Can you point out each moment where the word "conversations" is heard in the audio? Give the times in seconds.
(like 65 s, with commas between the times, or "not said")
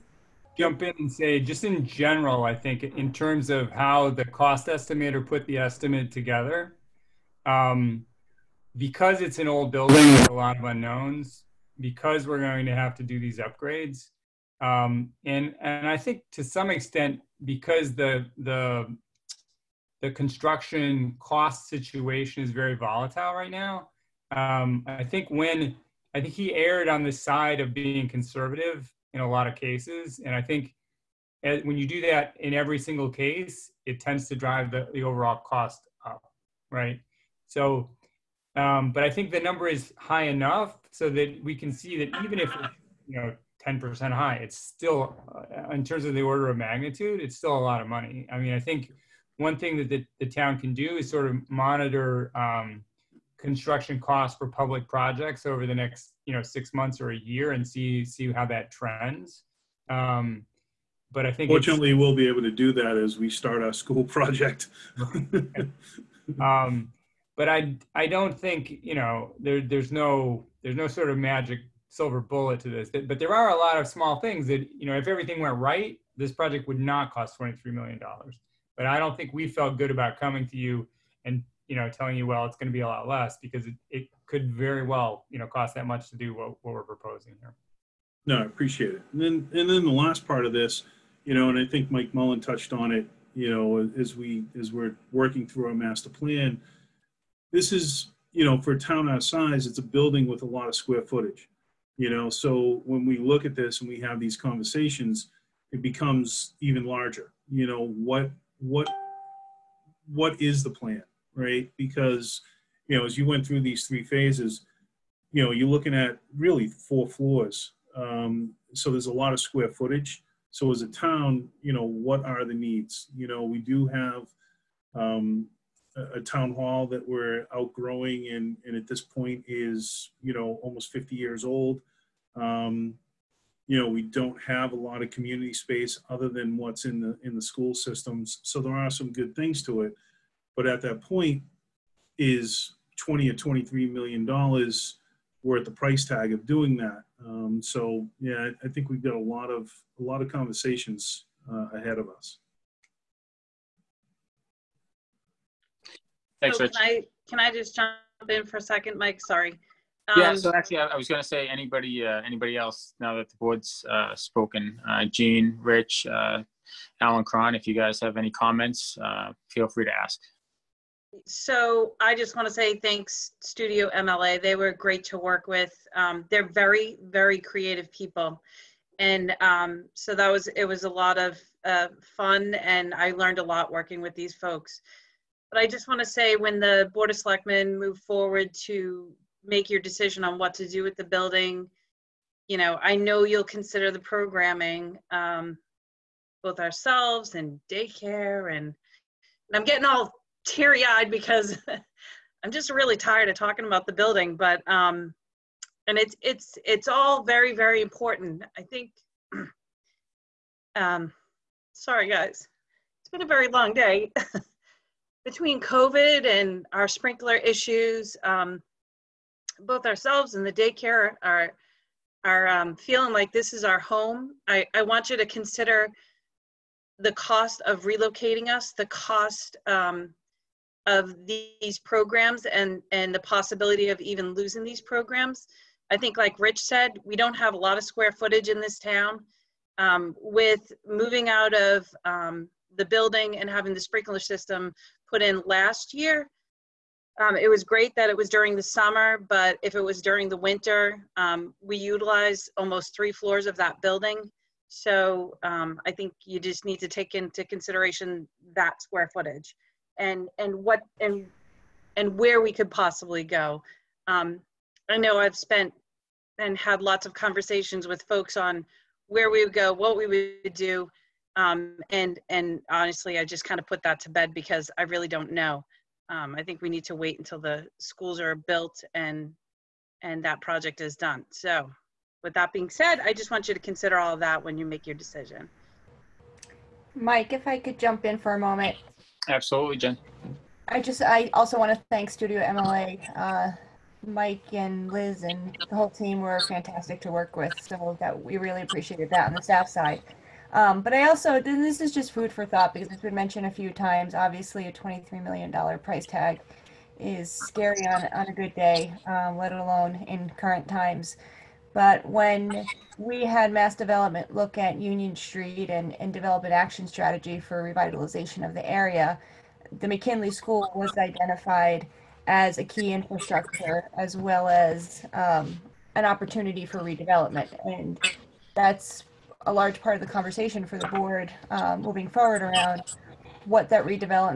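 104 s, 150 s, 267 s, 330 s.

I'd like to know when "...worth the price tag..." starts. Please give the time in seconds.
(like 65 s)
145 s.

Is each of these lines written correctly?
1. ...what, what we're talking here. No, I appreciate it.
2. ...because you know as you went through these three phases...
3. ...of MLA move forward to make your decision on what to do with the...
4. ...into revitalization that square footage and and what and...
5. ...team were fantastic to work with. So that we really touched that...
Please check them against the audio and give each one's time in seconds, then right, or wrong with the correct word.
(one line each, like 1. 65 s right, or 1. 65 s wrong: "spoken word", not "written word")
1. 86 s wrong: "proposing", not "talking"
2. 111 s right
3. 187 s wrong: "Selectmen", not "MLA"
4. 257 s wrong: "consideration", not "revitalization"
5. 295 s wrong: "appreciated", not "touched".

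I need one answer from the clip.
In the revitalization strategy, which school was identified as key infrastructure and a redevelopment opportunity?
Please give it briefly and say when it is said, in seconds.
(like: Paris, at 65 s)
McKinley School, at 319 s.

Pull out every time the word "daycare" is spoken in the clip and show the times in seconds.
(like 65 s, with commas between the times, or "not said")
197 s, 220 s.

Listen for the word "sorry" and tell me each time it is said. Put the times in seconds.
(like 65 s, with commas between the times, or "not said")
159 s, 211 s.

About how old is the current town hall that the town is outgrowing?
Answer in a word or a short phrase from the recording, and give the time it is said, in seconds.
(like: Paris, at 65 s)
almost 50 years, at 130 s.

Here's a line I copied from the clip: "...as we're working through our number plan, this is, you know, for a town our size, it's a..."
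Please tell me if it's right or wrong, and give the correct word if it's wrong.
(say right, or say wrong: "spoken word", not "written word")
wrong: "master", not "number".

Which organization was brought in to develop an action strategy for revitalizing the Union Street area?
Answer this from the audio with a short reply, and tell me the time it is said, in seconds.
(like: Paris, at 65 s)
Mass Development, at 313 s.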